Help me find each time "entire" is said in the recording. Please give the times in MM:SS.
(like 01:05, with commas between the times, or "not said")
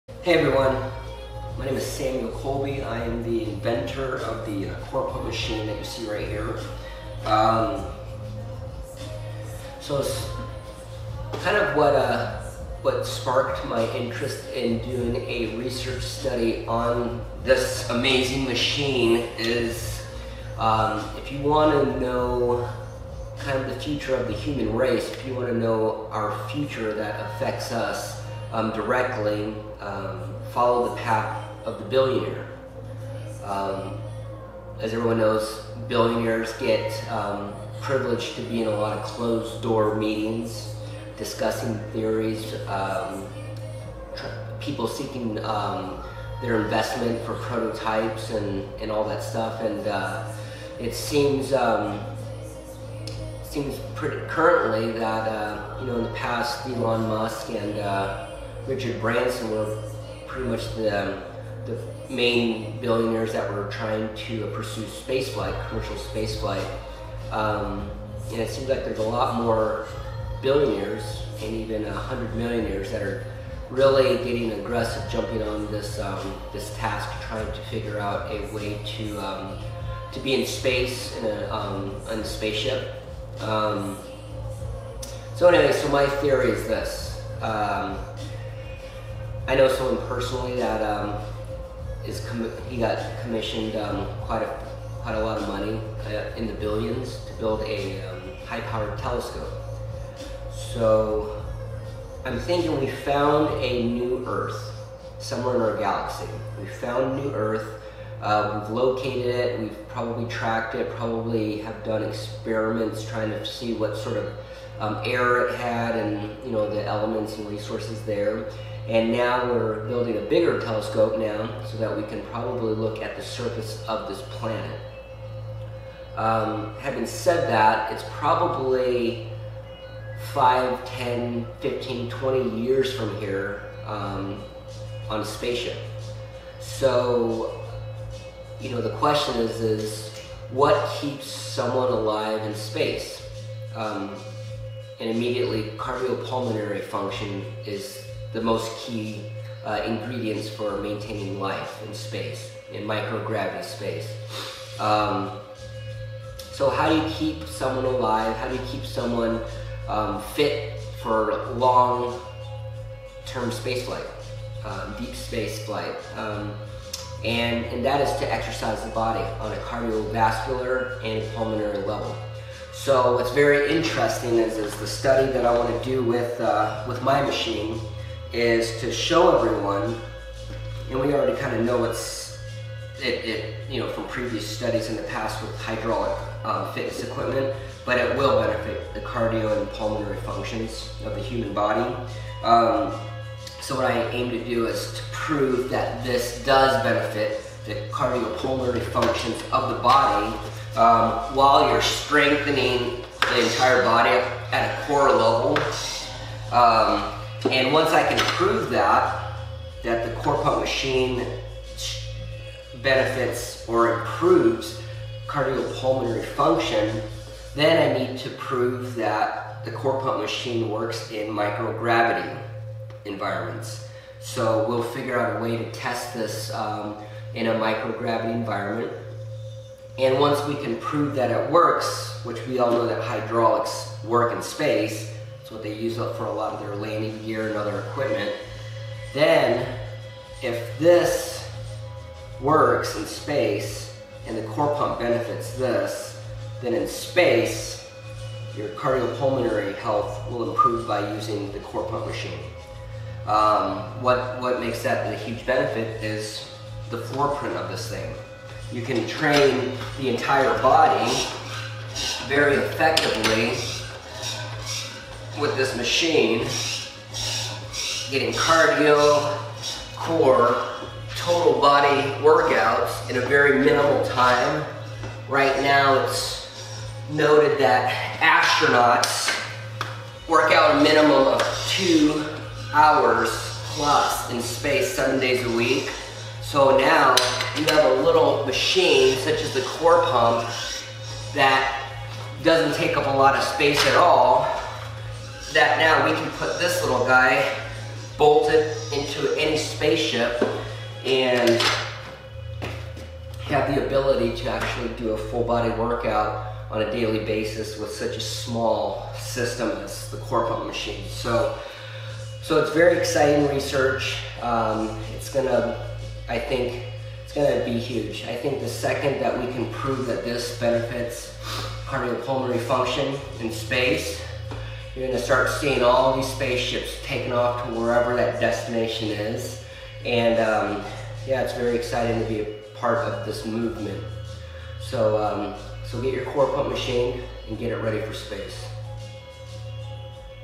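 03:23, 04:20.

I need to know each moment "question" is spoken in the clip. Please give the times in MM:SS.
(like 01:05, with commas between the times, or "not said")
02:18.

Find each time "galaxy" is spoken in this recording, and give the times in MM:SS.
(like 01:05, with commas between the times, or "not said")
01:45.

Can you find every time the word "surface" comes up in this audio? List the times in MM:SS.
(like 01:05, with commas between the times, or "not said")
02:03.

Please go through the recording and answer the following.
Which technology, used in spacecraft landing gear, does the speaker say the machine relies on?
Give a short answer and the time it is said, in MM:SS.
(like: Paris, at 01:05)
hydraulics, at 03:53.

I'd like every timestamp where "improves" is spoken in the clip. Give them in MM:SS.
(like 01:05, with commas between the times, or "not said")
03:34, 04:10.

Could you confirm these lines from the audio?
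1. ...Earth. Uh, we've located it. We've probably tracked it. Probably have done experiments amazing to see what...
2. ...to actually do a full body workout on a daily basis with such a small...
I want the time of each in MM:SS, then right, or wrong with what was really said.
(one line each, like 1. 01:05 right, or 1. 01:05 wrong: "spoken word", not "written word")
1. 01:47 wrong: "trying", not "amazing"
2. 05:04 right.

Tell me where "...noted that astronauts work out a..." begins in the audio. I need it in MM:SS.
04:37.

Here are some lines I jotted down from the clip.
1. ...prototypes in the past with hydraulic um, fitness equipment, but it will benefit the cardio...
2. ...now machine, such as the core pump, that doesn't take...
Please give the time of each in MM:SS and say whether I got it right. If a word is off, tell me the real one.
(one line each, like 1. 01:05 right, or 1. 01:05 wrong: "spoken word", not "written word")
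1. 03:04 wrong: "studies", not "prototypes"
2. 04:46 right.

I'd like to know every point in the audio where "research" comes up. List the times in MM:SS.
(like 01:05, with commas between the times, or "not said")
00:15, 05:13.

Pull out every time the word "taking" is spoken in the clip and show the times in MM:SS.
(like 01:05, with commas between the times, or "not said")
05:27.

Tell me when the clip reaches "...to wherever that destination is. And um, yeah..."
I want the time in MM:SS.
05:27.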